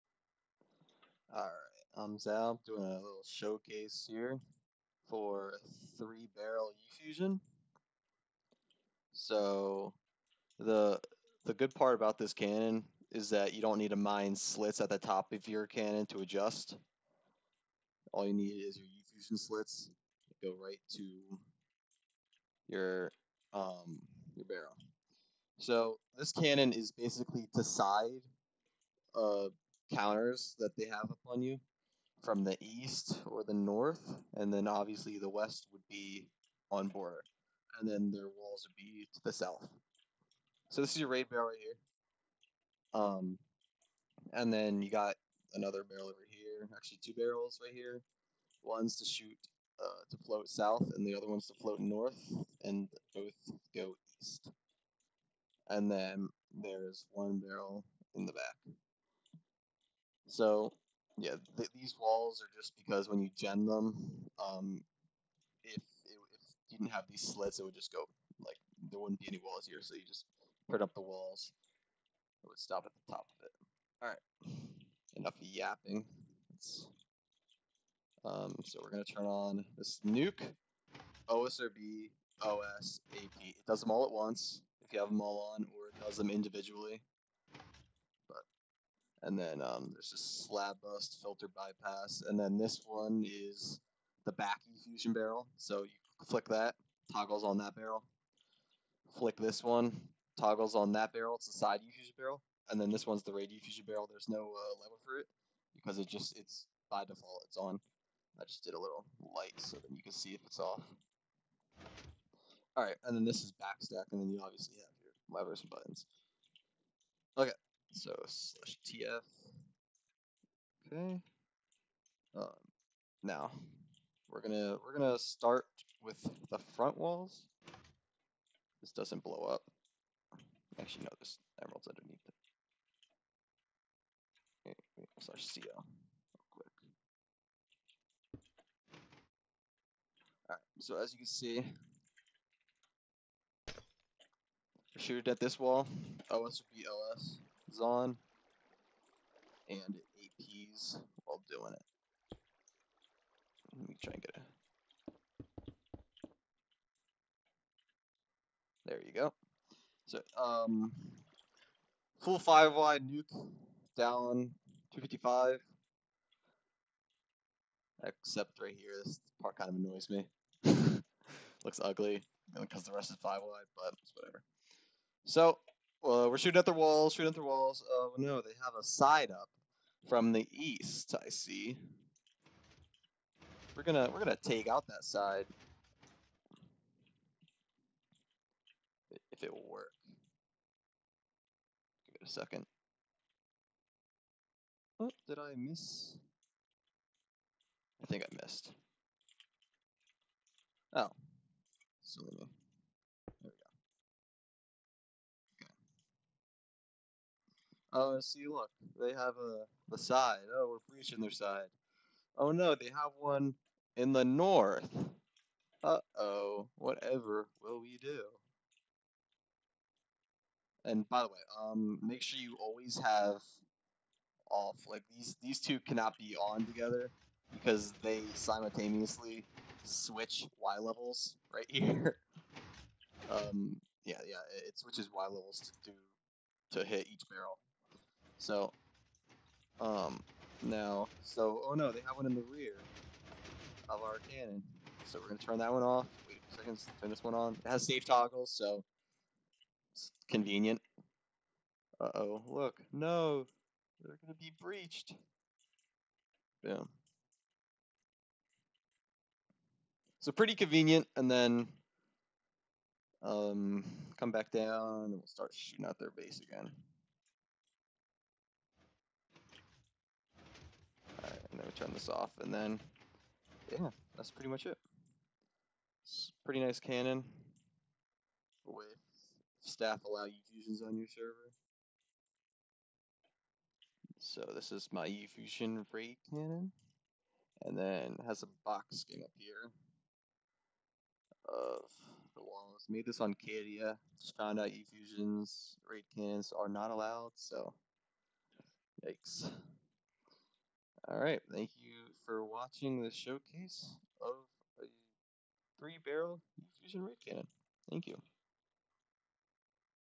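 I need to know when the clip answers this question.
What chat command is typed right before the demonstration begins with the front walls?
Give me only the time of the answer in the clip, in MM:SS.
01:58.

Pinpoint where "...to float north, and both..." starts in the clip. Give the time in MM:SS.
00:51.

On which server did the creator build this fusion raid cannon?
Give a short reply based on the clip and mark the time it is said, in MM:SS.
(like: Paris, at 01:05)
Cadia, at 04:53.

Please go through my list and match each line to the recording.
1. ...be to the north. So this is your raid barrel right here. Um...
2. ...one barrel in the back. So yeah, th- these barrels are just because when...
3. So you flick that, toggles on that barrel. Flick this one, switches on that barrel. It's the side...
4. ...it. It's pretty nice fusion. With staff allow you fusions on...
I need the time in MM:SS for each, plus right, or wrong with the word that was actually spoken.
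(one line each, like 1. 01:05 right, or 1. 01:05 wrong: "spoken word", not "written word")
1. 00:38 wrong: "south", not "north"
2. 00:57 wrong: "walls", not "barrels"
3. 01:35 wrong: "toggles", not "switches"
4. 04:34 wrong: "cannon", not "fusion".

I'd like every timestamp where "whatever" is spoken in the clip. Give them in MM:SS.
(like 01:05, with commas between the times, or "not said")
02:54, 03:36.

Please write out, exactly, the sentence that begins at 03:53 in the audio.
um, yeah, yeah, it switches Y levels to do to hit each barrel.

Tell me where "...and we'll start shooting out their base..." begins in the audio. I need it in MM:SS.
04:25.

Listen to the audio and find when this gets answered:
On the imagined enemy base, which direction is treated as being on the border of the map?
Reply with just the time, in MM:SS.
00:35.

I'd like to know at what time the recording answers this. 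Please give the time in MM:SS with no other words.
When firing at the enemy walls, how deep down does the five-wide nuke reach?
02:44.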